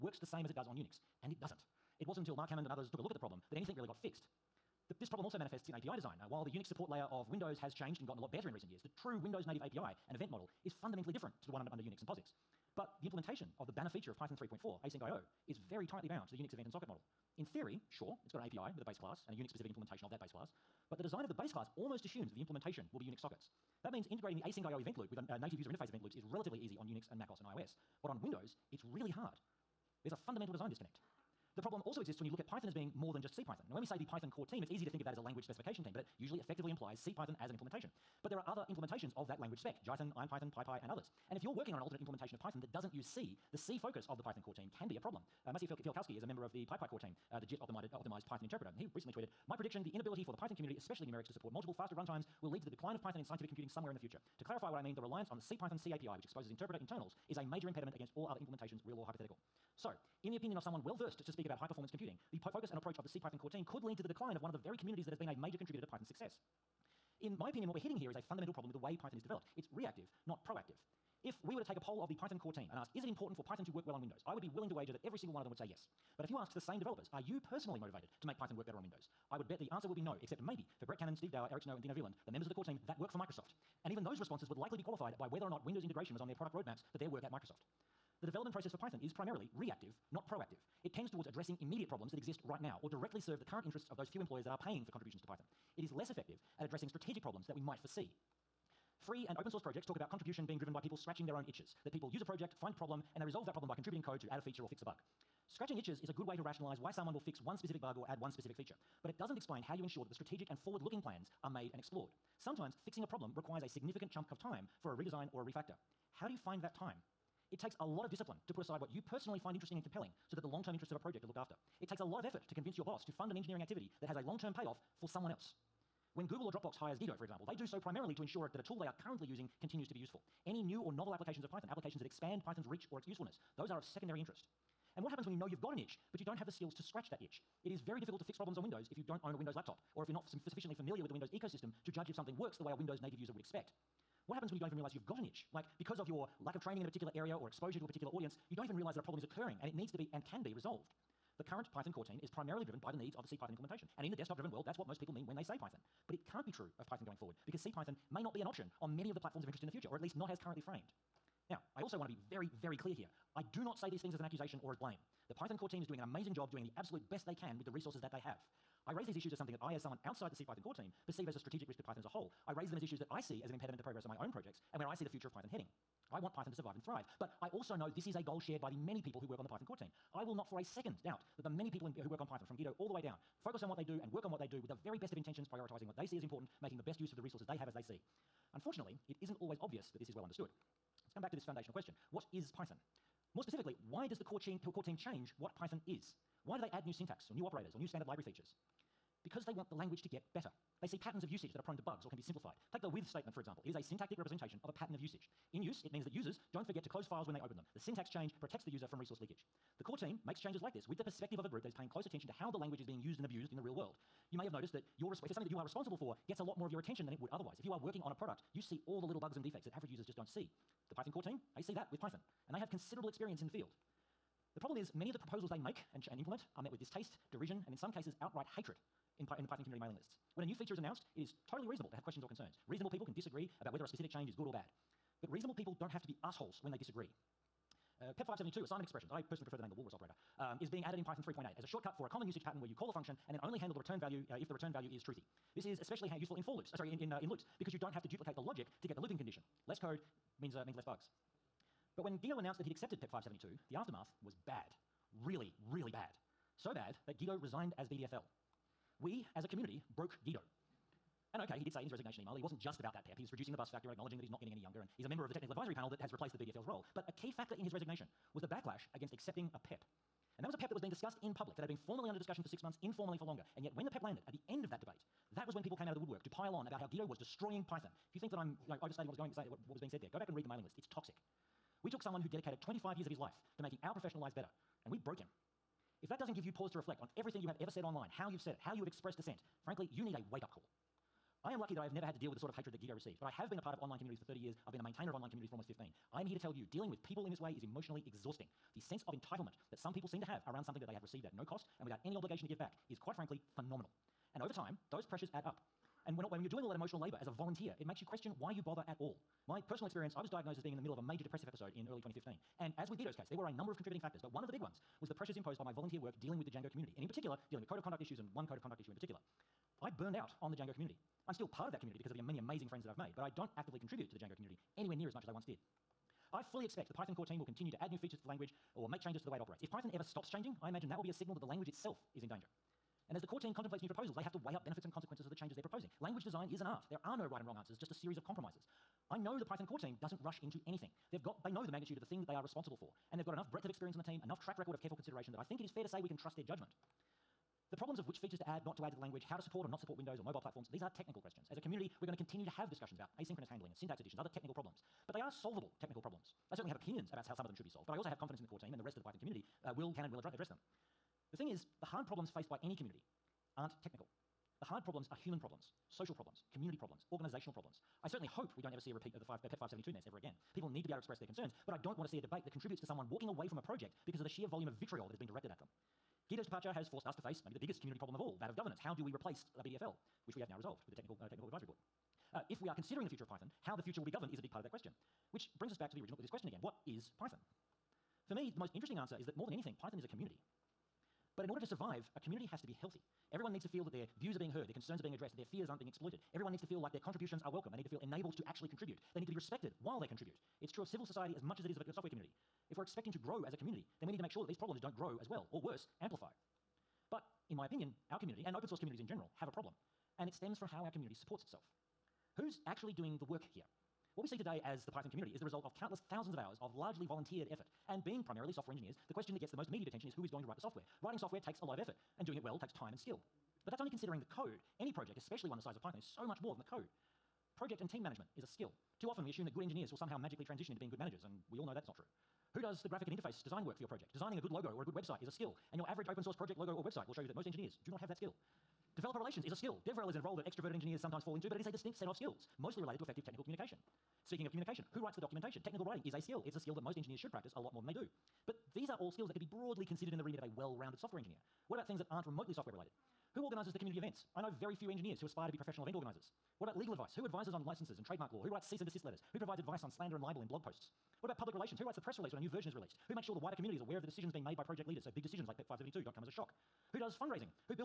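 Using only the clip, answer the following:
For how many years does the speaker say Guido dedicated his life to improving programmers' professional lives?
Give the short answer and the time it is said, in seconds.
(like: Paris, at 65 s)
25 years, at 282 s.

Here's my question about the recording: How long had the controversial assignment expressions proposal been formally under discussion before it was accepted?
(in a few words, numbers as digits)
6 months.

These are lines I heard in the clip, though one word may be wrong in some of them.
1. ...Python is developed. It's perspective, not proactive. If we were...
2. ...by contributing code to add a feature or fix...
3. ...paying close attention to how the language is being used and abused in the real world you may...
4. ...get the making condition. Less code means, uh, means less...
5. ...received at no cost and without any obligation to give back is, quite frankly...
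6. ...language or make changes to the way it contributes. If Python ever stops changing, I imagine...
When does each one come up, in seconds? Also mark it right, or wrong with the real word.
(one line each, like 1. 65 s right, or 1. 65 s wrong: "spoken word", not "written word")
1. 68 s wrong: "reactive", not "perspective"
2. 103 s right
3. 211 s right
4. 248 s wrong: "looping", not "making"
5. 301 s right
6. 328 s wrong: "operates", not "contributes".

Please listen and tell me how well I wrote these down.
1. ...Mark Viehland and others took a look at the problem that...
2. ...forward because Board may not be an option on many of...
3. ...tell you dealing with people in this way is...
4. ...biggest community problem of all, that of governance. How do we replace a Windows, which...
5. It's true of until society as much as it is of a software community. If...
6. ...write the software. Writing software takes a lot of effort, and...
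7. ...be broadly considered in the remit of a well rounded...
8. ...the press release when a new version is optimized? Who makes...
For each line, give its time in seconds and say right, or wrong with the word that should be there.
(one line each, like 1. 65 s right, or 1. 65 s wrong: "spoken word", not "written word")
1. 2 s wrong: "Hammond", not "Viehland"
2. 157 s wrong: "CPython", not "Board"
3. 296 s right
4. 377 s wrong: "BDFL", not "Windows"
5. 400 s wrong: "civil", not "until"
6. 420 s right
7. 449 s right
8. 461 s wrong: "released", not "optimized".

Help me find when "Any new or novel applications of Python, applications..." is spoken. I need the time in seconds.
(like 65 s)
130 s.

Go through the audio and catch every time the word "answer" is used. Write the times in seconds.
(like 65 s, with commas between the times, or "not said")
79 s, 337 s, 388 s.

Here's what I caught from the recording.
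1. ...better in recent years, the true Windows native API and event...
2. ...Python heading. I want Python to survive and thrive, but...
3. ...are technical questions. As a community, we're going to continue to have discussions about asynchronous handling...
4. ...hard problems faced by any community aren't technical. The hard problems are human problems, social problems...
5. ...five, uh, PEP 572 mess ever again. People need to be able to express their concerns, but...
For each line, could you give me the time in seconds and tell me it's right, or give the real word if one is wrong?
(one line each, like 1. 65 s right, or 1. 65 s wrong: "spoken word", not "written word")
1. 8 s right
2. 175 s right
3. 350 s right
4. 361 s right
5. 369 s right.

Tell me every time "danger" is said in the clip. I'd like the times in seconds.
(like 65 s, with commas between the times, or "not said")
332 s.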